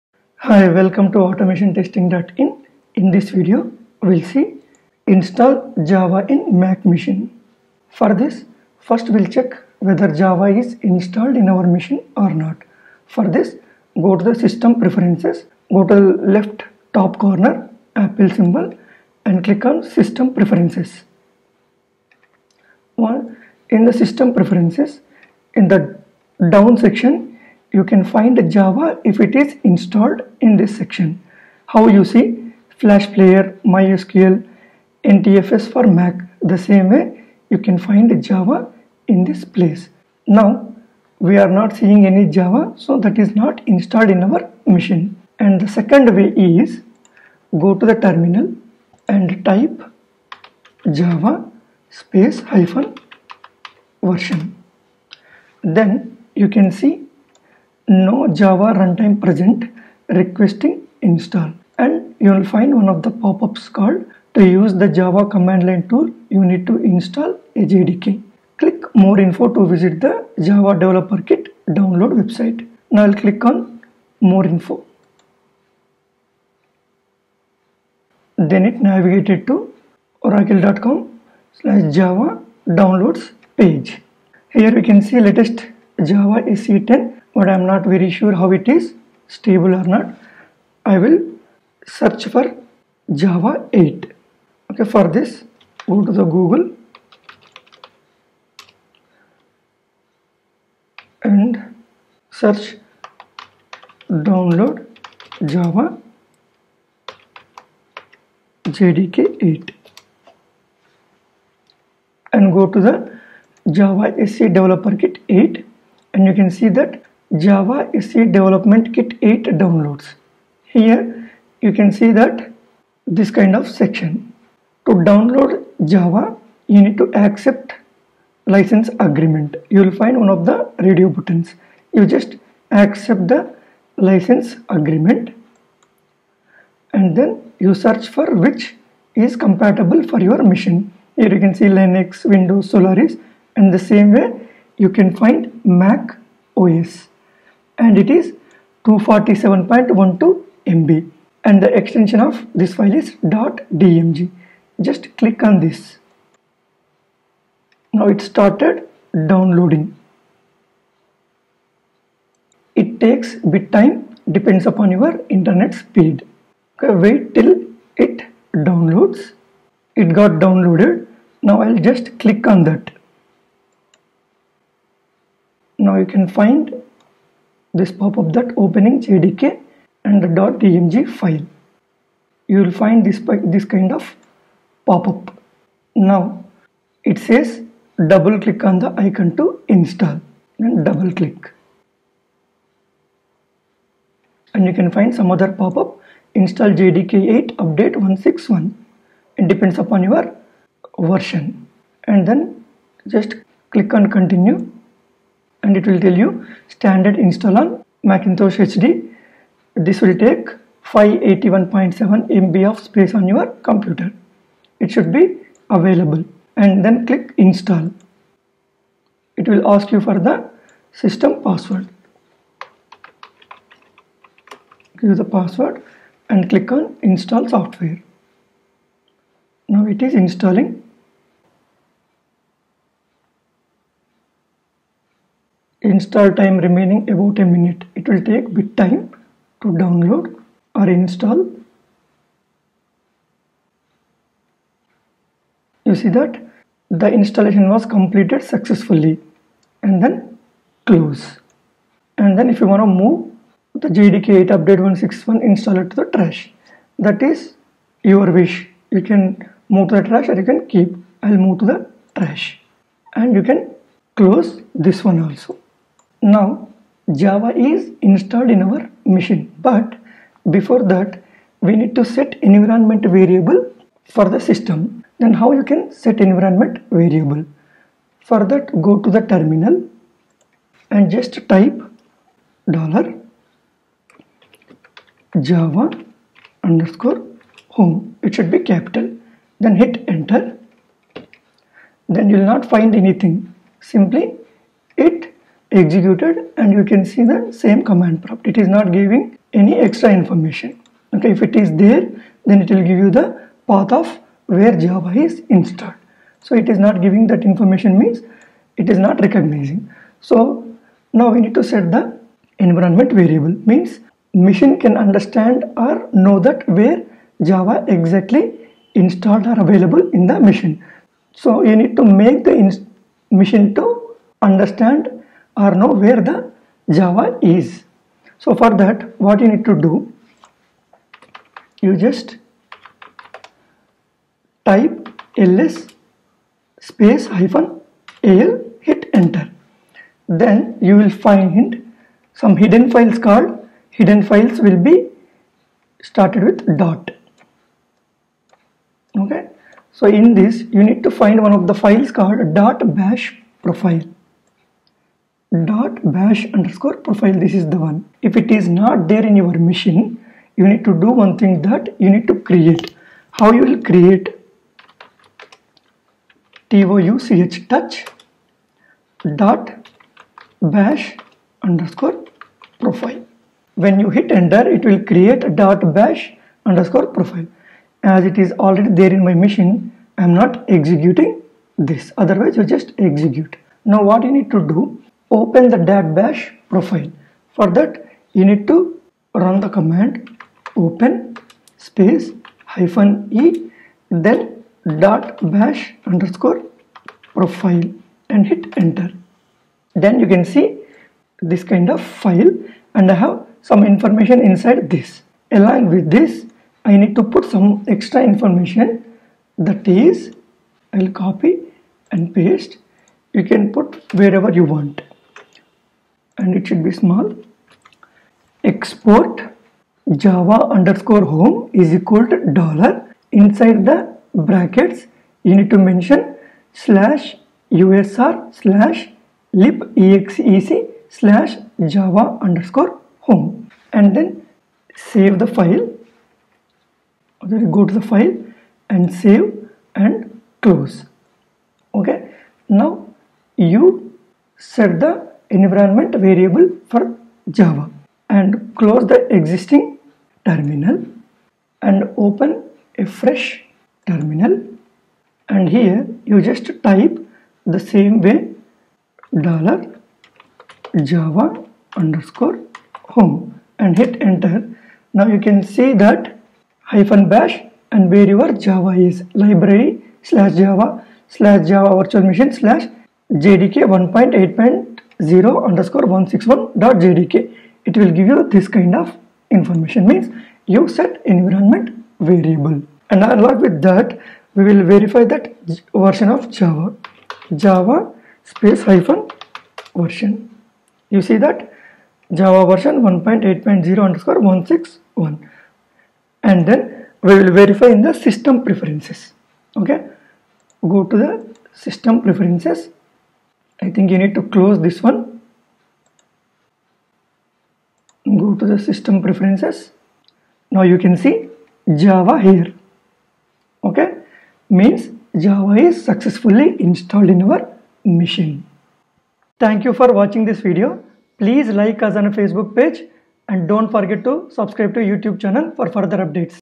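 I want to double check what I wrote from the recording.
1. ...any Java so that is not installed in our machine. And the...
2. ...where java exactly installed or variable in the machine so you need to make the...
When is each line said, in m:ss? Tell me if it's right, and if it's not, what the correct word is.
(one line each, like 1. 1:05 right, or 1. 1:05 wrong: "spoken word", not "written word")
1. 0:42 right
2. 5:16 wrong: "available", not "variable".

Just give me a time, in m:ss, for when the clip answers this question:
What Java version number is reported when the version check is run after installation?
8:13.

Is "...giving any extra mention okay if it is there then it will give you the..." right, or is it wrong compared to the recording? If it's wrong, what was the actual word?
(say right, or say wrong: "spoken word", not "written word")
wrong: "information", not "mention".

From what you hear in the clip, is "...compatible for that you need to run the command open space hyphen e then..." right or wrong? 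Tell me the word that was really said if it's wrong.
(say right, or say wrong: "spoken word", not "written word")
wrong: "profile", not "compatible".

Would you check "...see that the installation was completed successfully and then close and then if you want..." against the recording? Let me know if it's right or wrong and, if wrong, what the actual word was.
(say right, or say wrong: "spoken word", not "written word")
right.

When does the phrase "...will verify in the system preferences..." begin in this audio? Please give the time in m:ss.
8:17.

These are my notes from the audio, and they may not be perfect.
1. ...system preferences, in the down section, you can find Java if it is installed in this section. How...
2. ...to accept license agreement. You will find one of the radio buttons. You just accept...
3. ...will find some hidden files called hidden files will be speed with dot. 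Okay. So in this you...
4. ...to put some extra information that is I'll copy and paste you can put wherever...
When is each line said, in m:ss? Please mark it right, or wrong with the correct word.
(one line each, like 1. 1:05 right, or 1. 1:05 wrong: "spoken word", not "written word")
1. 0:23 right
2. 2:06 right
3. 5:40 wrong: "started", not "speed"
4. 6:47 right.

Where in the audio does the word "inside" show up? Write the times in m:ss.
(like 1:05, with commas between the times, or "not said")
6:44, 7:03.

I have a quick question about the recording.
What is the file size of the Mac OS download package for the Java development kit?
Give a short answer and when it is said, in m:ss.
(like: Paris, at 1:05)
247.12 MB, at 2:28.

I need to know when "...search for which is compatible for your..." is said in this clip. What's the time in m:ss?
2:17.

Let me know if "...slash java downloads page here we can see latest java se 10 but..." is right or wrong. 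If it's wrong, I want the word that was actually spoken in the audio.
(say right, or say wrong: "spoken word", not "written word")
right.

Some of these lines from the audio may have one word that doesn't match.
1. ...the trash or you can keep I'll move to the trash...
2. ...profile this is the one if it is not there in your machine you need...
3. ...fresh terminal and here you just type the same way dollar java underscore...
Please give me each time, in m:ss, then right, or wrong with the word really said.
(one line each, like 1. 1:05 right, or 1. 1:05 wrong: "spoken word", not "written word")
1. 4:19 right
2. 5:57 right
3. 7:33 right.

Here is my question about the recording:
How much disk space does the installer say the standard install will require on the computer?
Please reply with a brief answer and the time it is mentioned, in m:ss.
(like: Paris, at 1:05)
581.7 MB, at 3:30.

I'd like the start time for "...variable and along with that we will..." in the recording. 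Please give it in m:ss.
8:02.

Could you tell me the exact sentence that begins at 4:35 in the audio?
Then how you can set environment variable?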